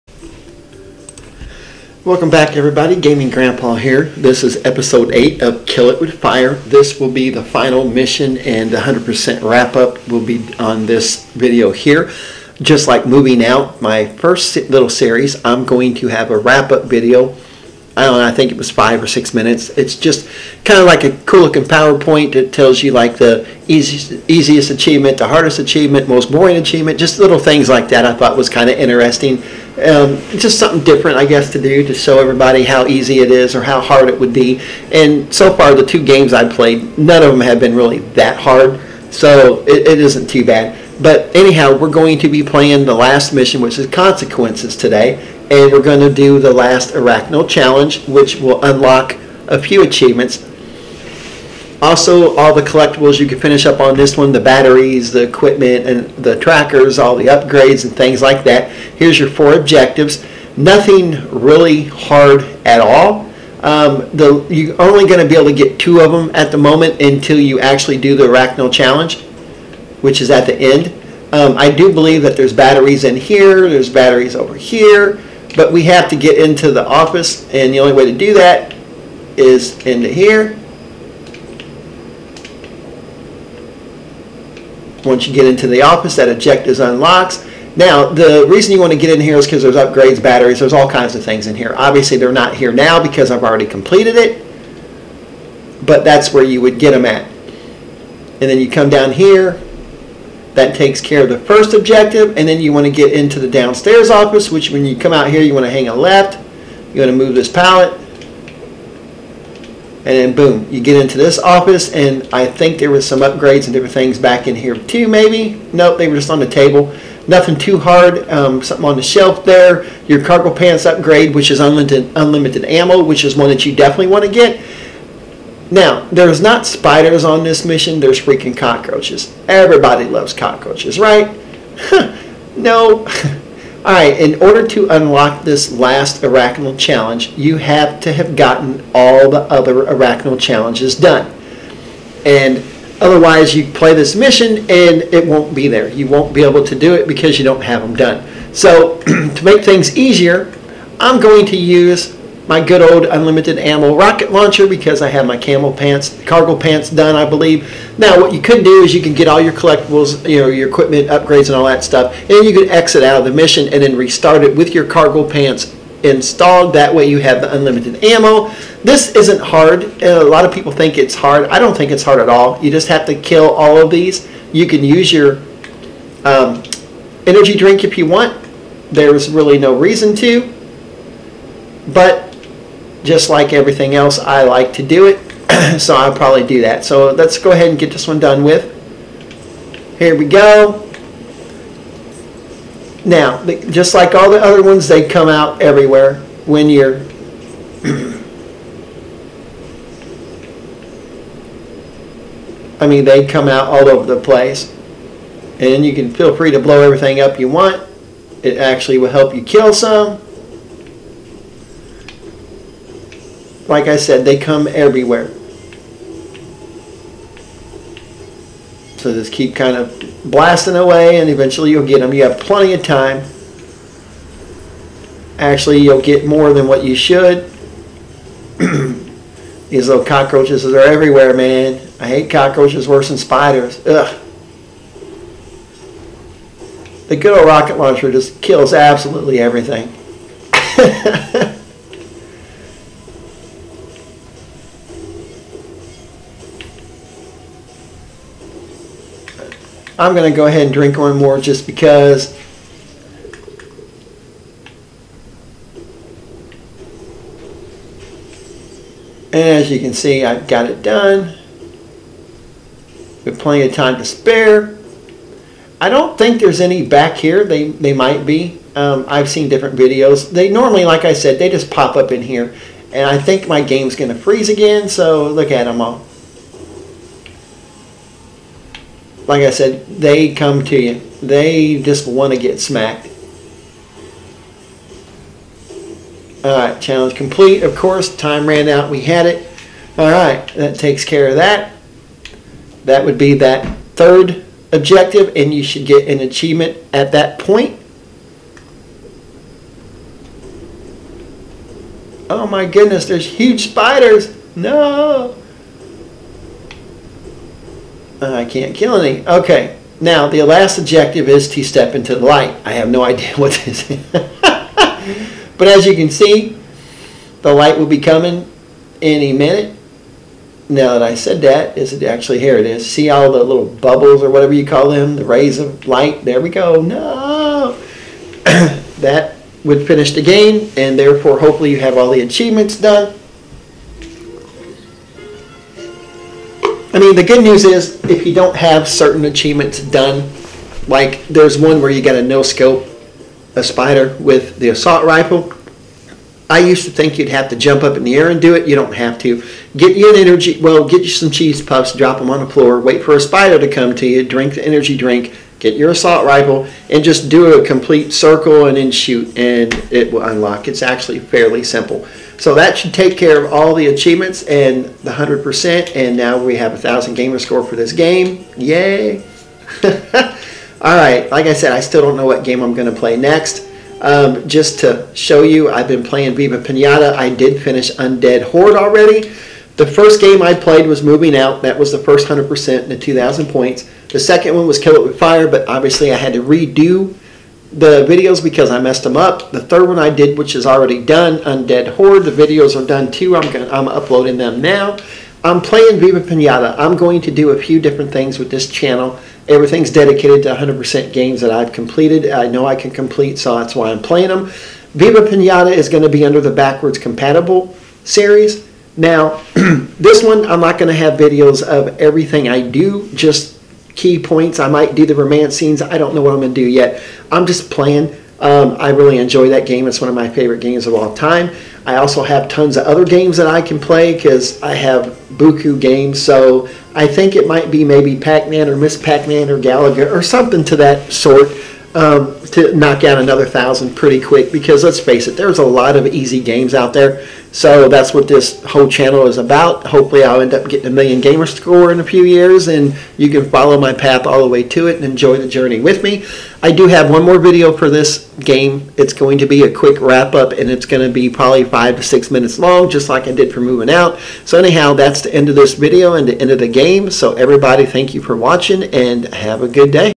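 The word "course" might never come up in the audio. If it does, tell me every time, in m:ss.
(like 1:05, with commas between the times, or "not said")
4:47.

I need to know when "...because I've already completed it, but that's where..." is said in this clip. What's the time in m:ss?
1:33.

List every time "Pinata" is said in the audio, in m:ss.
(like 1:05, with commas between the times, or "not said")
6:16, 6:36, 6:45.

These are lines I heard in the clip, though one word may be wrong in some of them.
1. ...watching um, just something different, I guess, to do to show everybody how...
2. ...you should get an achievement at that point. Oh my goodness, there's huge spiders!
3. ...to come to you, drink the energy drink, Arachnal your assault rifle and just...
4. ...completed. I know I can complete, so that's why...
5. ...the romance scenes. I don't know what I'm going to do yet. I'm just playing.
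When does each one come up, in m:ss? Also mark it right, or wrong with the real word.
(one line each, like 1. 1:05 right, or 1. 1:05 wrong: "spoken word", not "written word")
1. 0:28 wrong: "interesting", not "watching"
2. 4:55 right
3. 5:53 wrong: "Get", not "Arachnal"
4. 6:41 right
5. 6:55 right.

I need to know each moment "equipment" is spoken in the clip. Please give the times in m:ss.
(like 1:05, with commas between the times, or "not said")
0:55, 2:40.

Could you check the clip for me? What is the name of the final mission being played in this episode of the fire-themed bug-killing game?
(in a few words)
Consequences.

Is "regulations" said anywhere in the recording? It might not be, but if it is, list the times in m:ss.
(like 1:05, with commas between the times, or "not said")
not said.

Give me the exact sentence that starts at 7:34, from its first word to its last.
So, anyhow, that's the end of this video and the end of the game.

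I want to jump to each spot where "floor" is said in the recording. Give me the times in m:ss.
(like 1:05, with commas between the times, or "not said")
5:52.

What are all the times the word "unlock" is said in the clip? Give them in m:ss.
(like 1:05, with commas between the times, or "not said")
0:48, 1:26, 2:14, 6:00.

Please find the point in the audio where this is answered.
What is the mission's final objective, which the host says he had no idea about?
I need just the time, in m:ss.
5:11.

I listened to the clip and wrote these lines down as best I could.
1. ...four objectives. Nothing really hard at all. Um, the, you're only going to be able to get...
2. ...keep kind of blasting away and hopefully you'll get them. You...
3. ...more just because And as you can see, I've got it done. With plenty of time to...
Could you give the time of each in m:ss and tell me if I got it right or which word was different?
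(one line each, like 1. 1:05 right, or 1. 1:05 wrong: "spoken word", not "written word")
1. 0:59 right
2. 3:39 wrong: "eventually", not "hopefully"
3. 4:11 right.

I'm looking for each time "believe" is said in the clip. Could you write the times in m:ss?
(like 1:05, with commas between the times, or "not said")
1:11, 2:37.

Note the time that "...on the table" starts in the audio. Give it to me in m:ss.
1:56.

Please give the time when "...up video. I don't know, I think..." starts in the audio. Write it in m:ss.
0:16.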